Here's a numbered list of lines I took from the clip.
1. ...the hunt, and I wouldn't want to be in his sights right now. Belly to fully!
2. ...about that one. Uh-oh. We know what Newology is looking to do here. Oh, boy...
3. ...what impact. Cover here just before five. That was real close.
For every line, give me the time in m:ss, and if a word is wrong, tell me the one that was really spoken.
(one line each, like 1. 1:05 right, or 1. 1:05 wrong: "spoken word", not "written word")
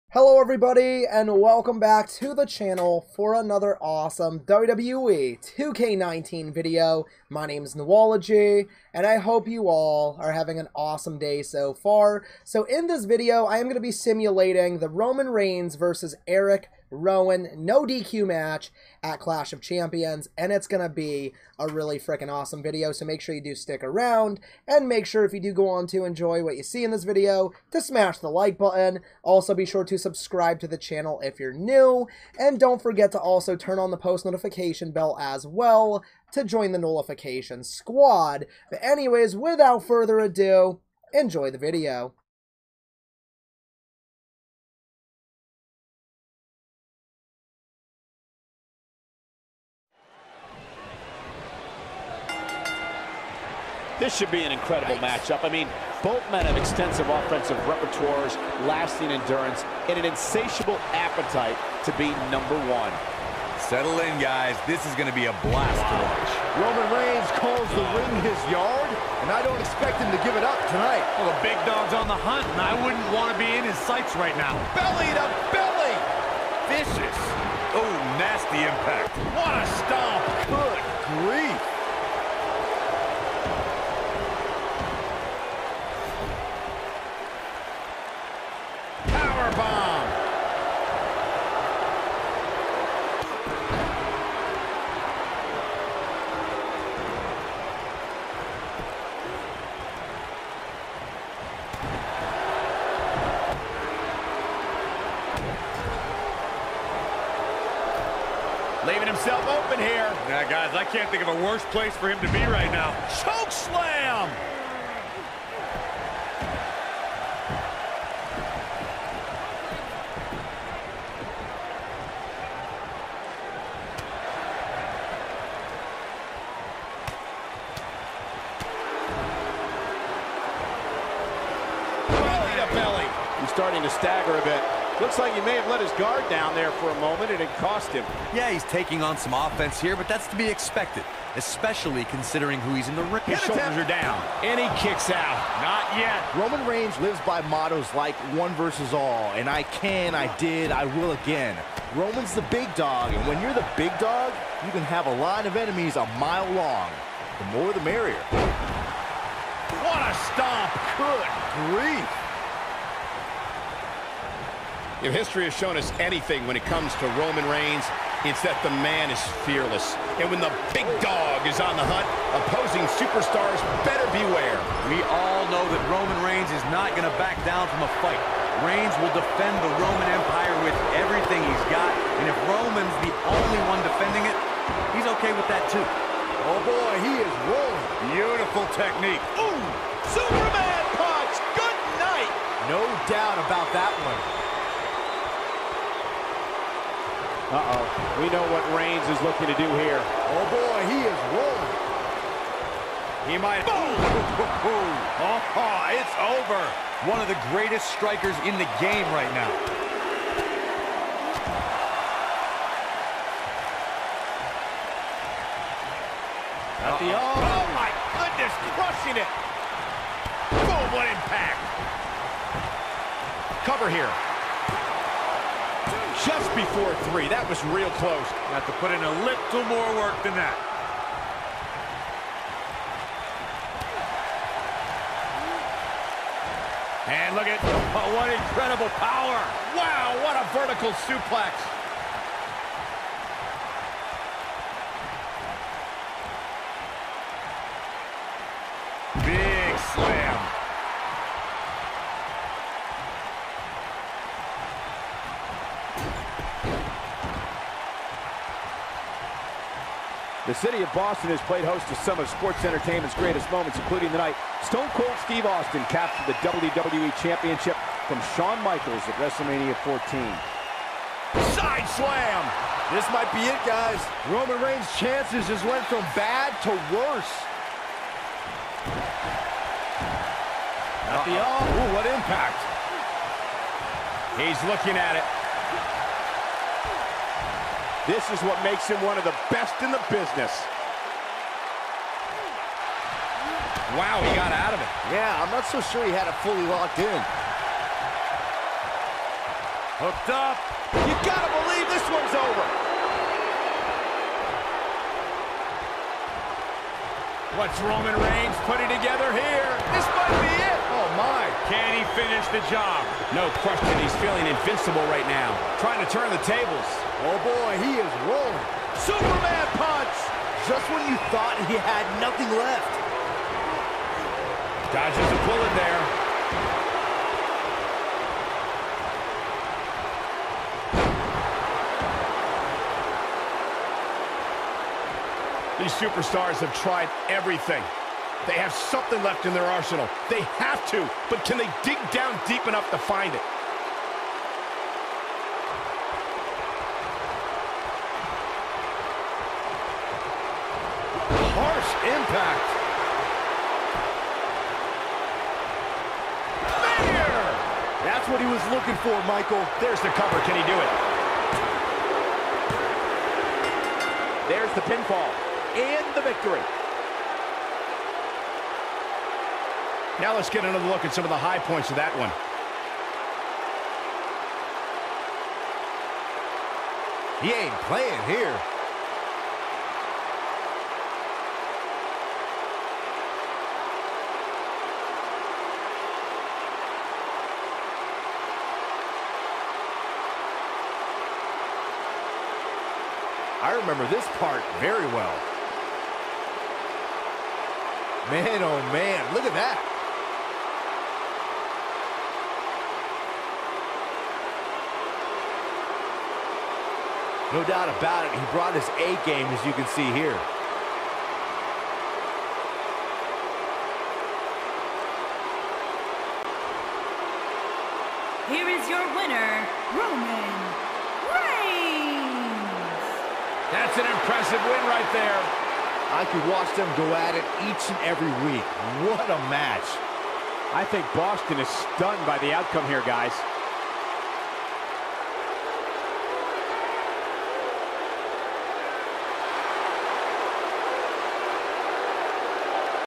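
1. 1:12 wrong: "belly", not "fully"
2. 3:13 wrong: "Reigns", not "Newology"
3. 3:40 wrong: "three", not "five".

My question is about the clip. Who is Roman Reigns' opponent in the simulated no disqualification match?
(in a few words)
Erick Rowan.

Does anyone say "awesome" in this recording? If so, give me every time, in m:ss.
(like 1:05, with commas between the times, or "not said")
0:03, 0:10, 0:22.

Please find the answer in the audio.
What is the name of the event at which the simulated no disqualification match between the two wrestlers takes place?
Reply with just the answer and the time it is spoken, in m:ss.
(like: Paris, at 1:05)
Clash of Champions, at 0:19.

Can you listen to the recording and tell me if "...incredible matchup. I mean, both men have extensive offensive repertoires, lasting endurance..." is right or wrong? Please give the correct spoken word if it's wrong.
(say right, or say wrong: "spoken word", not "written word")
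right.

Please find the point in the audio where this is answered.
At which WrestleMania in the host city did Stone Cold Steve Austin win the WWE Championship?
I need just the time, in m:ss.
4:29.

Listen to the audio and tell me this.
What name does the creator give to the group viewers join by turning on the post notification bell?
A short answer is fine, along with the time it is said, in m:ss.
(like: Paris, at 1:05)
nullification squad, at 0:36.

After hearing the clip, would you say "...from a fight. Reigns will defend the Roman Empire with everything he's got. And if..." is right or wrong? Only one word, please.
right.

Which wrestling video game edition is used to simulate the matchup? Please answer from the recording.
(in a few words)
WWE 2K19.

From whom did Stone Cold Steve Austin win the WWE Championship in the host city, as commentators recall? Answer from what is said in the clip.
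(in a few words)
Shawn Michaels.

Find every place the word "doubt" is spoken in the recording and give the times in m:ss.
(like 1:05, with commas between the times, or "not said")
3:13, 6:47.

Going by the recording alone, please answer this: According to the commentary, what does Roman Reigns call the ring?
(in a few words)
his yard.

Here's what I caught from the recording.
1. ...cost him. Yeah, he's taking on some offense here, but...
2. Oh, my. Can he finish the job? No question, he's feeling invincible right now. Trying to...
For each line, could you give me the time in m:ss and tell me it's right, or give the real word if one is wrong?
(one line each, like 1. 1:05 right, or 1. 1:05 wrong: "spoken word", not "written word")
1. 2:17 right
2. 5:10 right.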